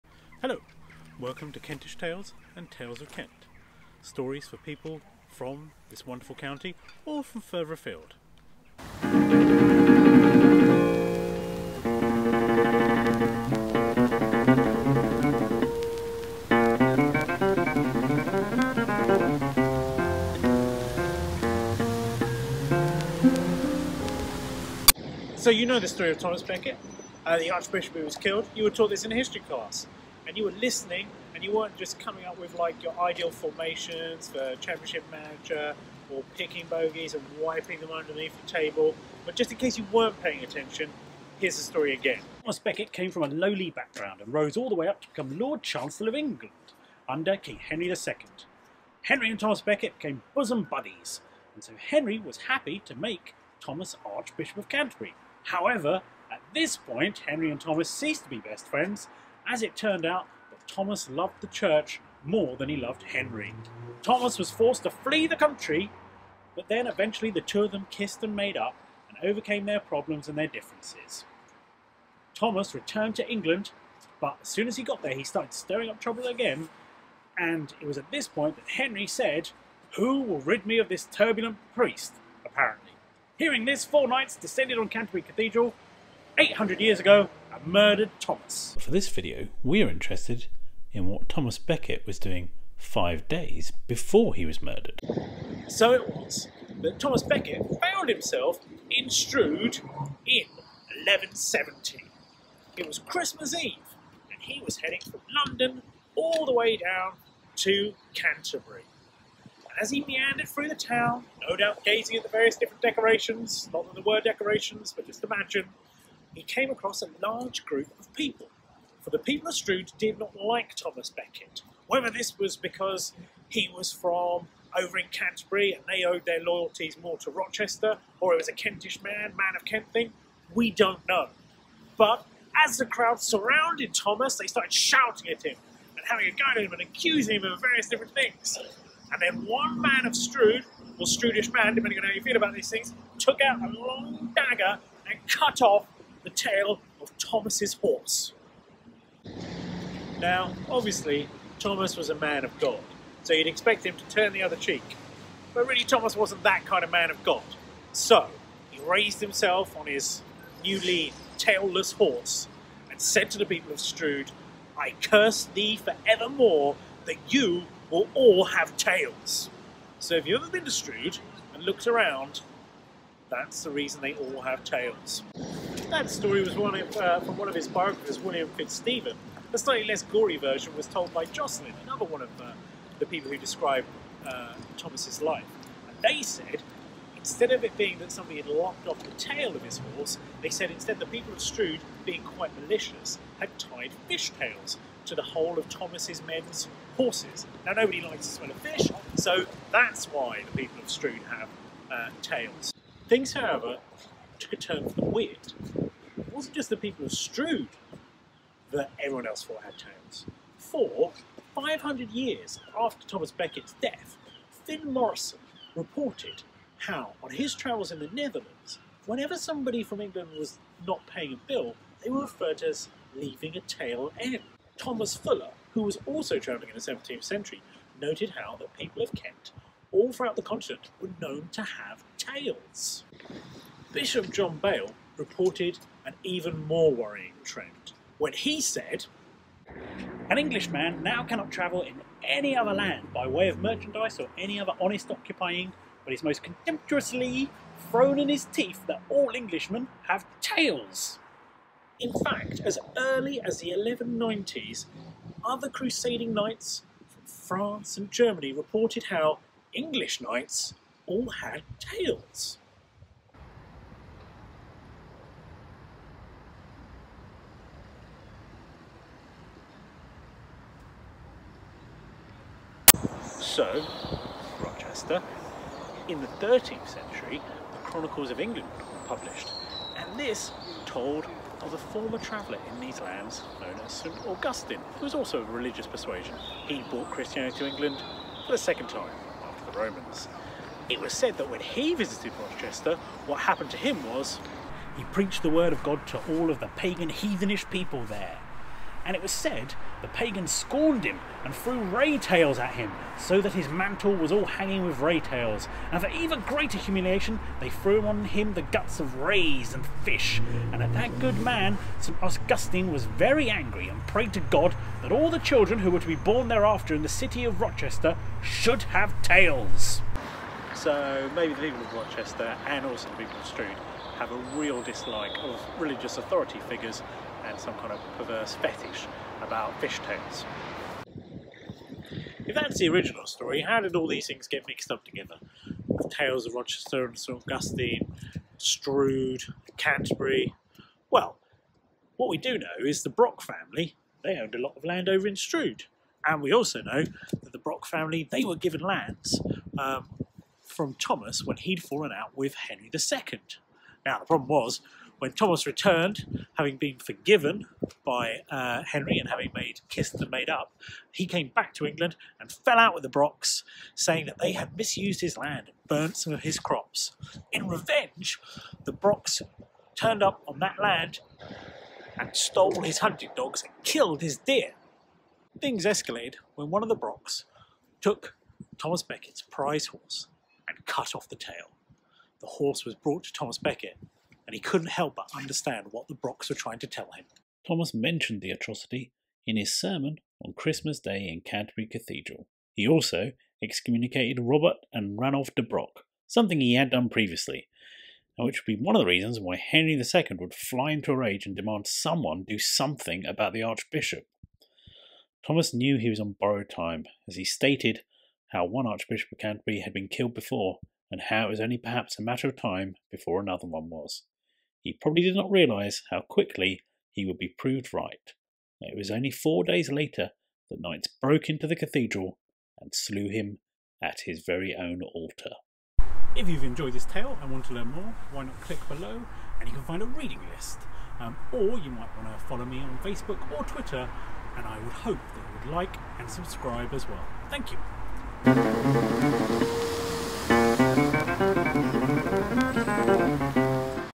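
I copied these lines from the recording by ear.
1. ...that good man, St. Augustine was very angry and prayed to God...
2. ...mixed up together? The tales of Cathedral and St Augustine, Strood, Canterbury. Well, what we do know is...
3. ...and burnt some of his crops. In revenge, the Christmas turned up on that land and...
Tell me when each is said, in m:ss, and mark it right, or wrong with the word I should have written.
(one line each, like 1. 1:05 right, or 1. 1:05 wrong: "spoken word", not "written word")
1. 5:10 right
2. 5:34 wrong: "Rochester", not "Cathedral"
3. 6:05 wrong: "Brocks", not "Christmas".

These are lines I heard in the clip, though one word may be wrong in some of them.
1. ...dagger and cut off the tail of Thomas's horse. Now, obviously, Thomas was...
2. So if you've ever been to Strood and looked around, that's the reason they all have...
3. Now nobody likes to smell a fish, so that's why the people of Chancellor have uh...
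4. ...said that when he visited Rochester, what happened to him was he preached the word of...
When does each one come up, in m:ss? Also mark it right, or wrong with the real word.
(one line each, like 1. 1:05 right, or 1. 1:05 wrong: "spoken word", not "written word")
1. 2:24 right
2. 2:49 right
3. 3:17 wrong: "Strood", not "Chancellor"
4. 4:51 right.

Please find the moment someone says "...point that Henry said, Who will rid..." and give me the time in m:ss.
1:18.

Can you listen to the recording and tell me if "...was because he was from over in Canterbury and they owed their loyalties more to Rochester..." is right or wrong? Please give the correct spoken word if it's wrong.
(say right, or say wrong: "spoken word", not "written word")
right.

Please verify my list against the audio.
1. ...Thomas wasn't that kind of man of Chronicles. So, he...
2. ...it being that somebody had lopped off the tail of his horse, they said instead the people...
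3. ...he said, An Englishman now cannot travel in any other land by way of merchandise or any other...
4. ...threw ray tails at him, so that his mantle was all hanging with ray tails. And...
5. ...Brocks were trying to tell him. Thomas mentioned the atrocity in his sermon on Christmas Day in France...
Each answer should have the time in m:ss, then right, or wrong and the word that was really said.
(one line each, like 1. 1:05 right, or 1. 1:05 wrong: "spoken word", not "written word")
1. 2:35 wrong: "God", not "Chronicles"
2. 3:07 right
3. 3:58 right
4. 5:01 right
5. 6:26 wrong: "Canterbury", not "France".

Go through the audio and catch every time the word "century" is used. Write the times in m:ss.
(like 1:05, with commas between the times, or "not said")
3:47, 4:36.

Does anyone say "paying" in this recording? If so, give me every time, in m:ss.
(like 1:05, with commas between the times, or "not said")
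0:40, 3:41.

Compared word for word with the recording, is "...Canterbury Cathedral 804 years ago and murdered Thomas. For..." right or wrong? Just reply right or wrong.
wrong.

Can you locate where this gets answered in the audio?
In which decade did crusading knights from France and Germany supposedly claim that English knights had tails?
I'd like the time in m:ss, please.
4:13.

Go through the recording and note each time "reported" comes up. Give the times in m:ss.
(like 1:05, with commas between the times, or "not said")
3:35, 3:55, 4:18.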